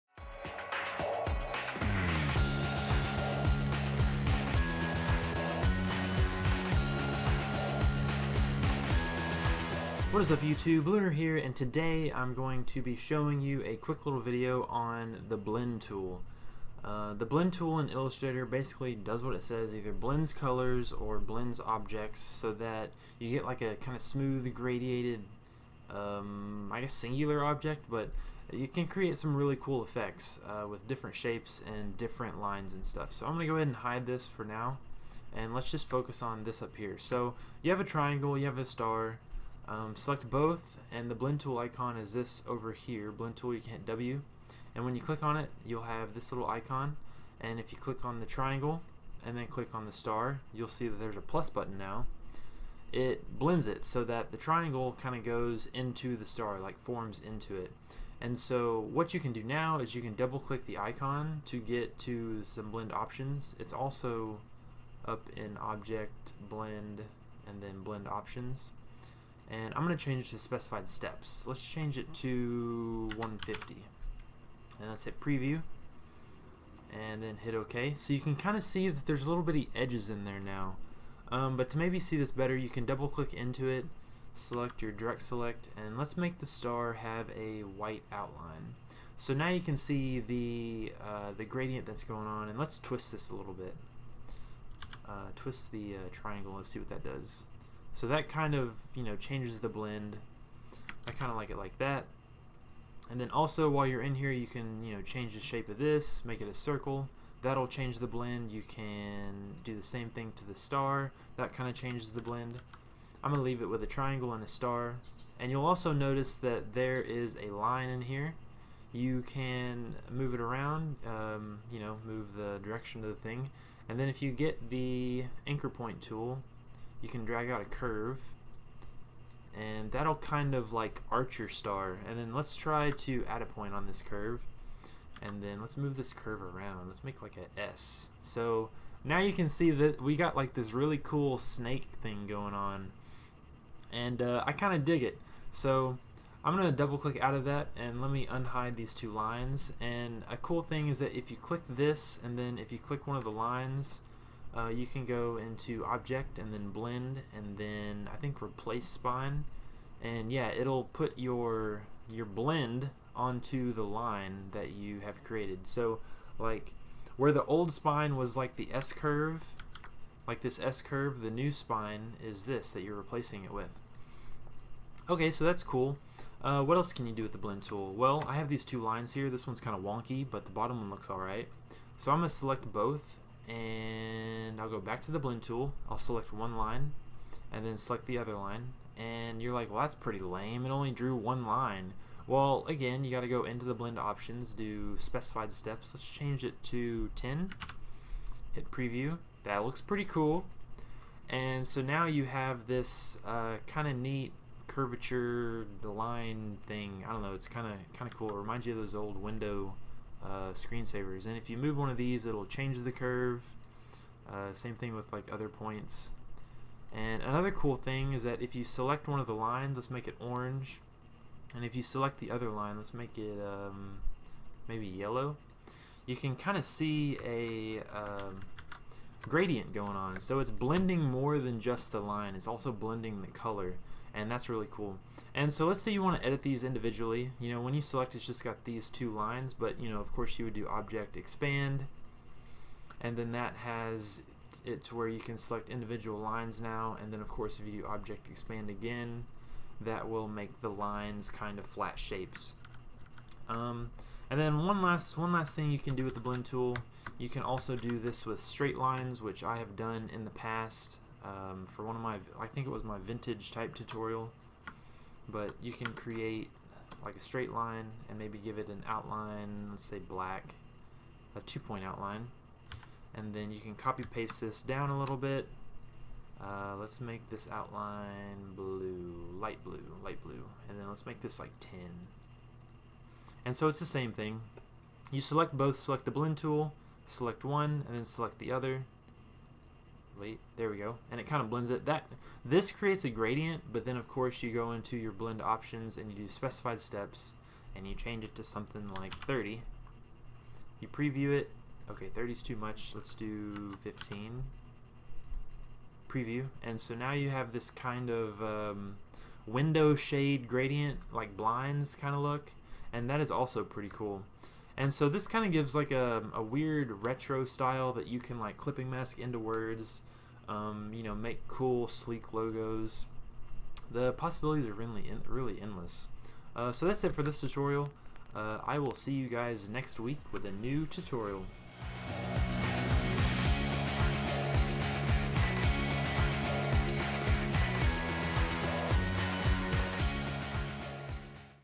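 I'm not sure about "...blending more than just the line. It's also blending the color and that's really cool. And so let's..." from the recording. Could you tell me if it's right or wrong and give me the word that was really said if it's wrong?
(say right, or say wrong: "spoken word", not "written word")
right.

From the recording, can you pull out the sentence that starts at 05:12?
And that is also pretty cool.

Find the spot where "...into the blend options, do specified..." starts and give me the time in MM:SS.
03:13.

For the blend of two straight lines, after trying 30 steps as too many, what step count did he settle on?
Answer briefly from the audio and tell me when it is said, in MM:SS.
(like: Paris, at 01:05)
15, at 05:03.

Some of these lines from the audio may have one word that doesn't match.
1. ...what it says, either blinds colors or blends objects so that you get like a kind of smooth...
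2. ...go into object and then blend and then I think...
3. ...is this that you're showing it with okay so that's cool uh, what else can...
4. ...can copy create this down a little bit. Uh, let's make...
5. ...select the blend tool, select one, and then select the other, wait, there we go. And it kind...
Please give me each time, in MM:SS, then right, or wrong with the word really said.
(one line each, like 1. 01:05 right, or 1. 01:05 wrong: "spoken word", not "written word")
1. 00:19 wrong: "blends", not "blinds"
2. 02:35 right
3. 02:52 wrong: "replacing", not "showing"
4. 04:33 wrong: "paste", not "create"
5. 04:45 right.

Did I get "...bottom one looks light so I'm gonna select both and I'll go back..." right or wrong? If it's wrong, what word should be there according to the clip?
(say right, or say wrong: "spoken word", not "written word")
wrong: "alright", not "light".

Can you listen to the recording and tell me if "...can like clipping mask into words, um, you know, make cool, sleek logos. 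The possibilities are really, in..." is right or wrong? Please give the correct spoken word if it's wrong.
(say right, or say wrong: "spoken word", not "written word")
right.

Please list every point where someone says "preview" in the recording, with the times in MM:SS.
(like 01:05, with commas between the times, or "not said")
01:15, 03:18, 05:00, 05:06.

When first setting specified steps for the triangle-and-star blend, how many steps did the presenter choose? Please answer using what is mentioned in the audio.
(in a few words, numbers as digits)
150.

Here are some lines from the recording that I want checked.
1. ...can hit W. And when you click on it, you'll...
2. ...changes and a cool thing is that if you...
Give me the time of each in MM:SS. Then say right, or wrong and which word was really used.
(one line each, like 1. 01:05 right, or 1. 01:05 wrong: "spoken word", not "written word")
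1. 00:43 right
2. 02:29 wrong: "lines", not "changes".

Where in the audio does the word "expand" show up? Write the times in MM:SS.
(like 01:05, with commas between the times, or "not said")
04:01, 04:08.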